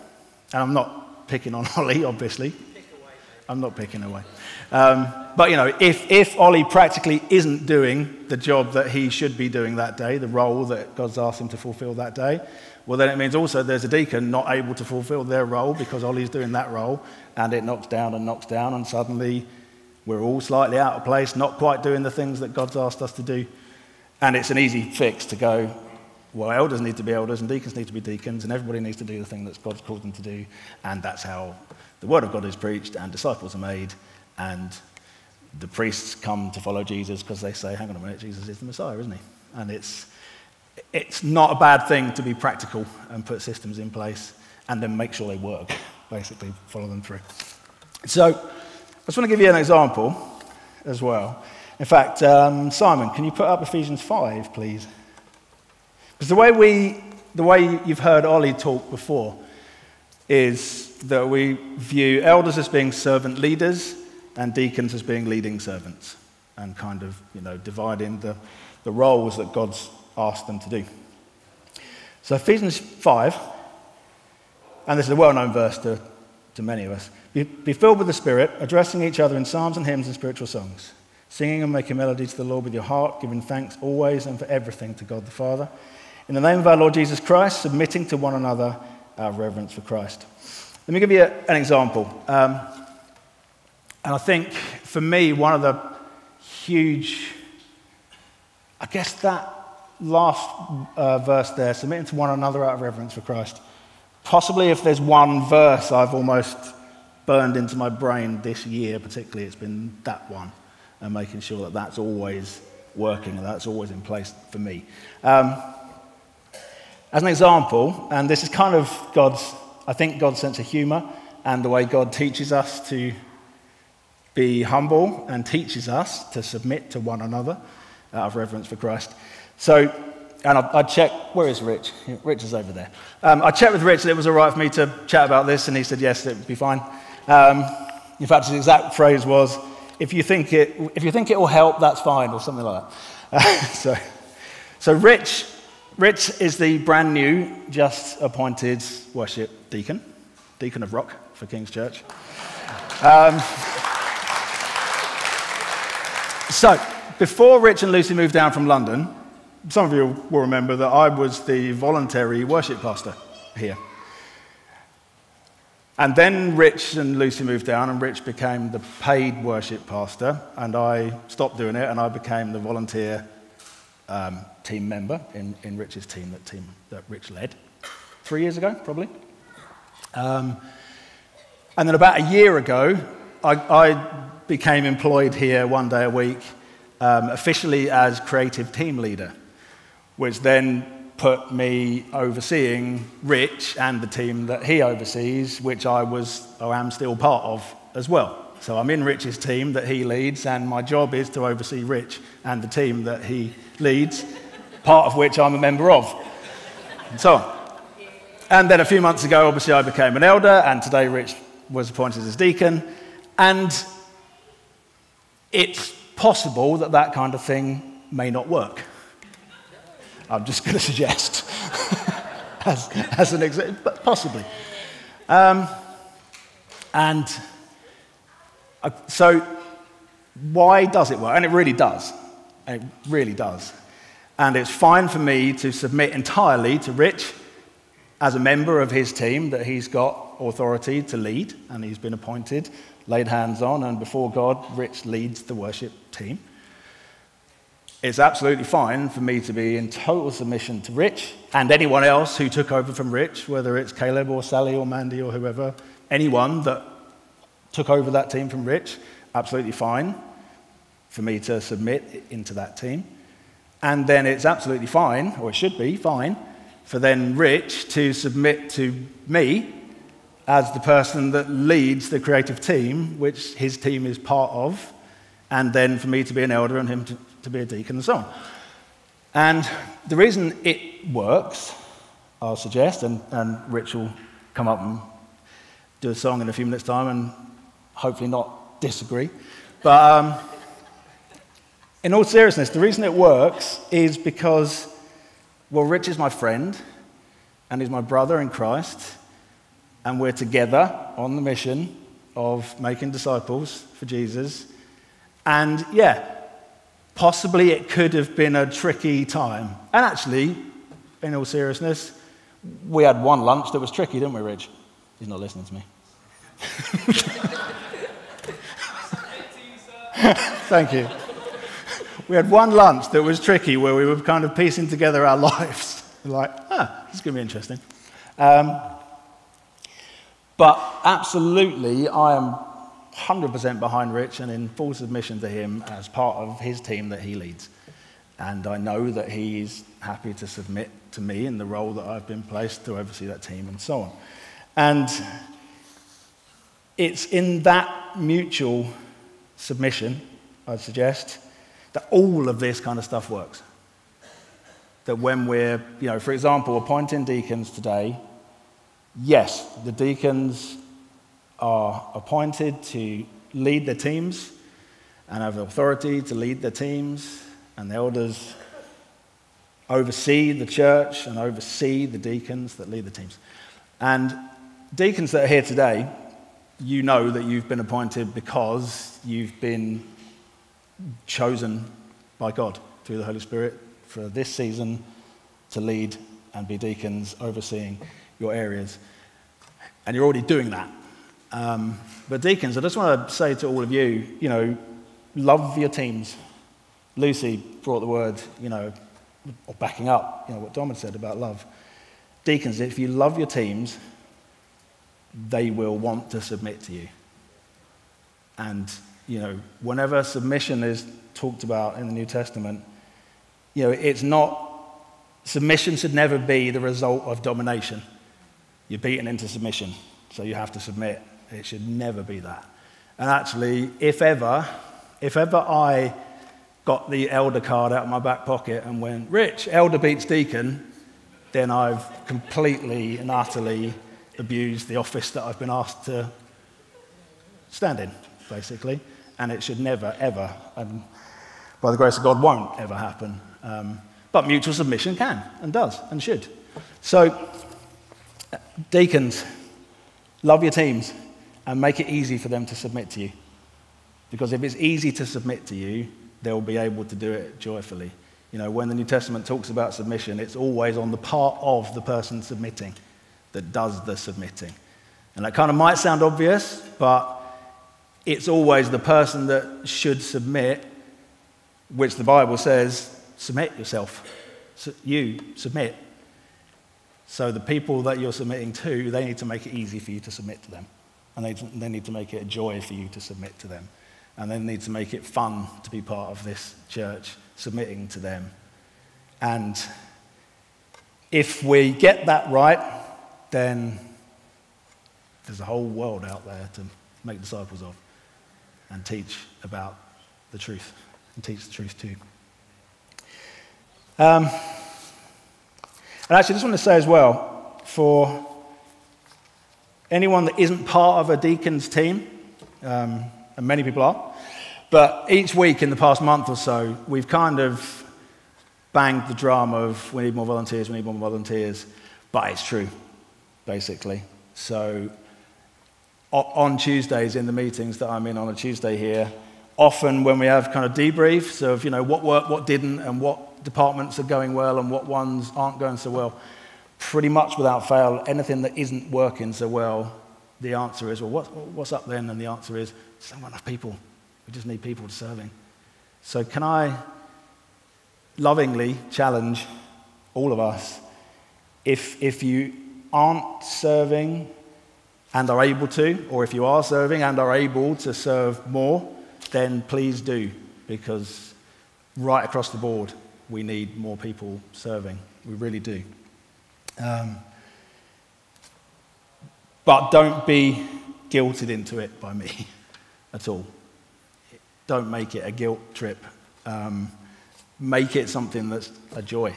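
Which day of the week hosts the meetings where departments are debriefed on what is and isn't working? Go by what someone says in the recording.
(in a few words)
Tuesday.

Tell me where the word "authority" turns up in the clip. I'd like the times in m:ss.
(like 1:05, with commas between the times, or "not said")
4:00, 6:05.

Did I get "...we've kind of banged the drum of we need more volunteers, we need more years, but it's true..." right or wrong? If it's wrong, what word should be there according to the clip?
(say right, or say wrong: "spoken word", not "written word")
wrong: "volunteers", not "years".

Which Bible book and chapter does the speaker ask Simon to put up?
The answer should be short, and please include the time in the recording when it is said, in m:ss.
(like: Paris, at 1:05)
Ephesians 5, at 0:53.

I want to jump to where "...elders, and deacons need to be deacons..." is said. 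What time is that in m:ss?
0:27.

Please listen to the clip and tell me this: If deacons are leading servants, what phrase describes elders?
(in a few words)
Servant leaders.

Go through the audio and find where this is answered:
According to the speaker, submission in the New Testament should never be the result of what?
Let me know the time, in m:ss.
6:57.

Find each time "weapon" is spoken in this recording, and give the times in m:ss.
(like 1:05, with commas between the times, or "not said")
not said.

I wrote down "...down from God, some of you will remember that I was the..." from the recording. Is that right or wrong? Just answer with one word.
wrong.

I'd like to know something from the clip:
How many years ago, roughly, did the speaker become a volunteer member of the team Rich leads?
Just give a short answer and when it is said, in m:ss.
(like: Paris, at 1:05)
3, at 2:58.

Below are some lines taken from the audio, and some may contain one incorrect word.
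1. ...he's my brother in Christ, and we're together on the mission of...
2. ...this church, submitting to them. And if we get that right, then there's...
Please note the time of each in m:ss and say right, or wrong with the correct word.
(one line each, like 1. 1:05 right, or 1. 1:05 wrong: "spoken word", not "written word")
1. 4:57 right
2. 8:06 right.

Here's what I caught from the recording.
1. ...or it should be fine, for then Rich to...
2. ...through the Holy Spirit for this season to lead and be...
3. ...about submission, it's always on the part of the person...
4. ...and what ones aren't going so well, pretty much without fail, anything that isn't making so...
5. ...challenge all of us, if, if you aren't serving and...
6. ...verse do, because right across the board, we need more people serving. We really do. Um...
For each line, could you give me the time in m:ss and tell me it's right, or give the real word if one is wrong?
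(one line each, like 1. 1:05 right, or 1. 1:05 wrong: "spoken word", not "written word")
1. 4:25 right
2. 6:23 right
3. 7:39 right
4. 8:54 wrong: "working", not "making"
5. 9:09 right
6. 9:19 wrong: "please", not "verse".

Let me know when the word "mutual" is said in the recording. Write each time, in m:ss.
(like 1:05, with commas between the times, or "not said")
5:48, 7:24.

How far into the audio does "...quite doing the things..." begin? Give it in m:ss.
0:21.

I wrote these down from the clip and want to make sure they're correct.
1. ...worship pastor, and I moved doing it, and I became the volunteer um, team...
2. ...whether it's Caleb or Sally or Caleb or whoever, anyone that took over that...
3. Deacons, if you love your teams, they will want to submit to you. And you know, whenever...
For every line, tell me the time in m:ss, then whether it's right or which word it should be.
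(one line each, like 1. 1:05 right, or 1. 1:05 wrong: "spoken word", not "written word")
1. 2:49 wrong: "stopped", not "moved"
2. 4:13 wrong: "Mandy", not "Caleb"
3. 6:42 right.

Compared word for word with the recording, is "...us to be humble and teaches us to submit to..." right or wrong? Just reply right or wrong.
right.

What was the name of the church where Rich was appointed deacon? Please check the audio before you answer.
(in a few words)
King's Church.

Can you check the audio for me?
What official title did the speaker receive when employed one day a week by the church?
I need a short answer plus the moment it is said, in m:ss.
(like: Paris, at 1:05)
Creative team leader, at 3:08.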